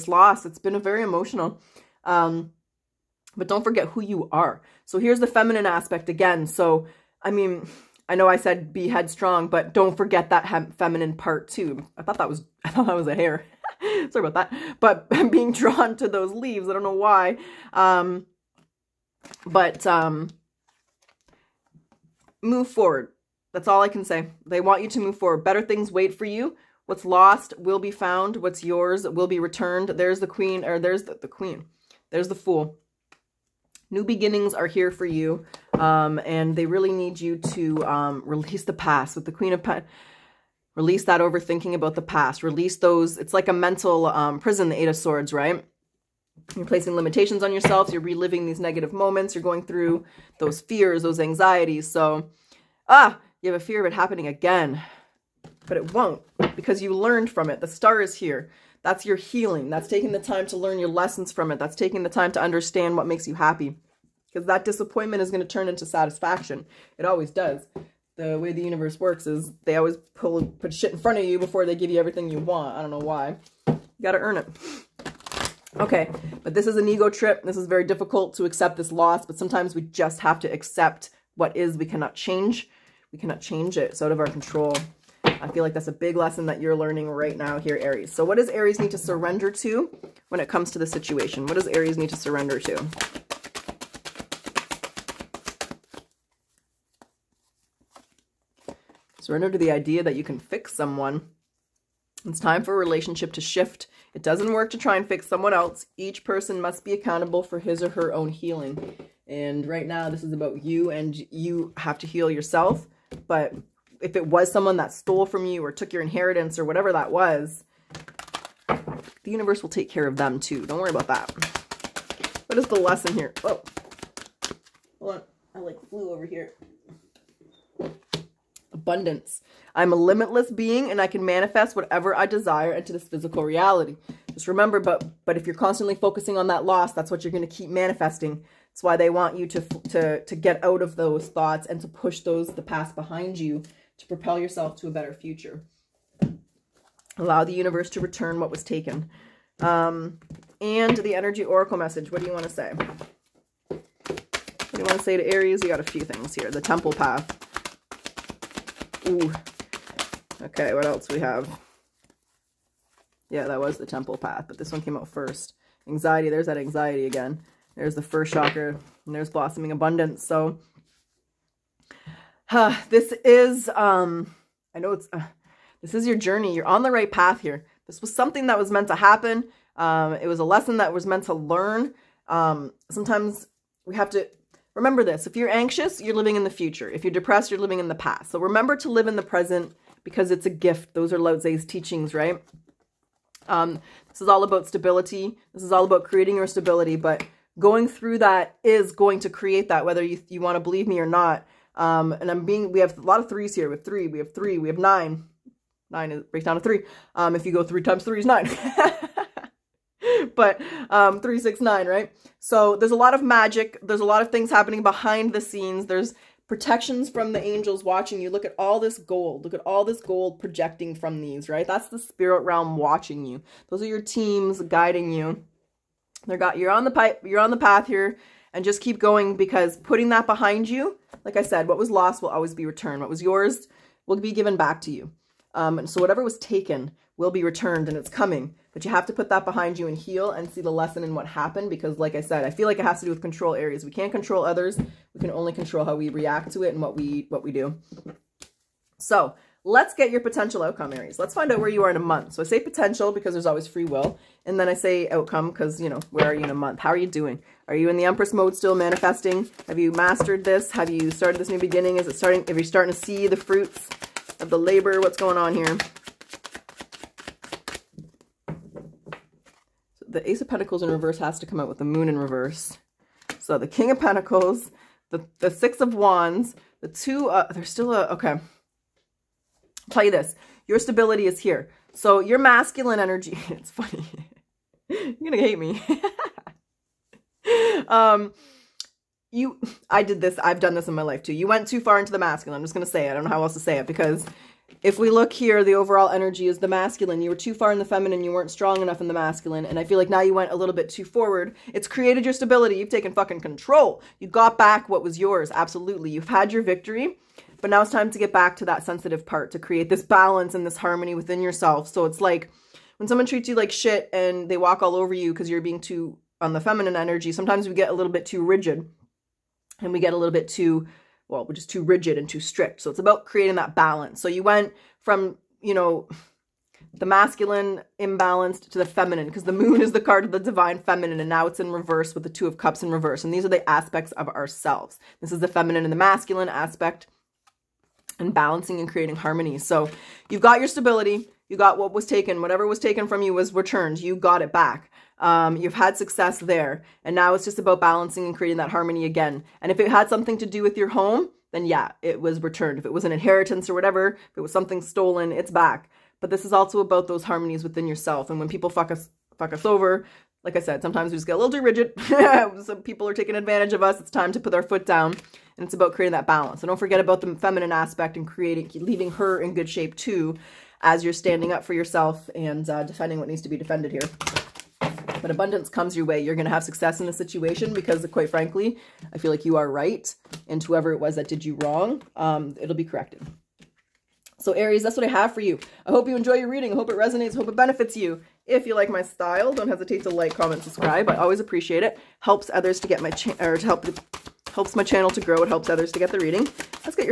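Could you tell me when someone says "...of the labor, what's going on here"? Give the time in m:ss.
4:24.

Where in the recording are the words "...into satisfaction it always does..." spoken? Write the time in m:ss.
1:05.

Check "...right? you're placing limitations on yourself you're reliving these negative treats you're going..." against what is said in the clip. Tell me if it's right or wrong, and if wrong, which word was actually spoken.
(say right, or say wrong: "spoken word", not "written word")
wrong: "moments", not "treats".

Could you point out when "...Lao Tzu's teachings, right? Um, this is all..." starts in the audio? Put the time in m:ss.
3:11.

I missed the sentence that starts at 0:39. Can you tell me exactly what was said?
With the queen of pentacles, release that overthinking about the past.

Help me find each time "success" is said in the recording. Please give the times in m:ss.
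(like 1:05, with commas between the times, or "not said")
5:45, 6:16.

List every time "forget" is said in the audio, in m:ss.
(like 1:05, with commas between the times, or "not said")
0:03, 0:09, 6:06.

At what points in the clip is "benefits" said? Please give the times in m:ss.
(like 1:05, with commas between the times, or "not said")
6:27.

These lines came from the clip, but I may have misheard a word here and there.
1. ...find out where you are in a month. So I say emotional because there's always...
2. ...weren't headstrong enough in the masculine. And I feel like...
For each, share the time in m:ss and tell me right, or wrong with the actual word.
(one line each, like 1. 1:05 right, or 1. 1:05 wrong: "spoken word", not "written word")
1. 4:11 wrong: "potential", not "emotional"
2. 4:58 wrong: "strong", not "headstrong".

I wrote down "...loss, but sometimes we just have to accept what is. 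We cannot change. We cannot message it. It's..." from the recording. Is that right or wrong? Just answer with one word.
wrong.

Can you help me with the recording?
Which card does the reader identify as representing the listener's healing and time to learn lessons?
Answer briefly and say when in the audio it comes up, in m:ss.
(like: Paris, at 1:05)
The Star, at 0:57.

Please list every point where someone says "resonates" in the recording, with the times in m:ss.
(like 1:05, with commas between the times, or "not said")
6:26.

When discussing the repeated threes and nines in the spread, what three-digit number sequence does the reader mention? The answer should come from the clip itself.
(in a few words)
369.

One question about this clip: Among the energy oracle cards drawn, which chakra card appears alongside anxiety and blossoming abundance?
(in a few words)
First chakra.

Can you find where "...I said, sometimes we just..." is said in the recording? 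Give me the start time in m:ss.
6:00.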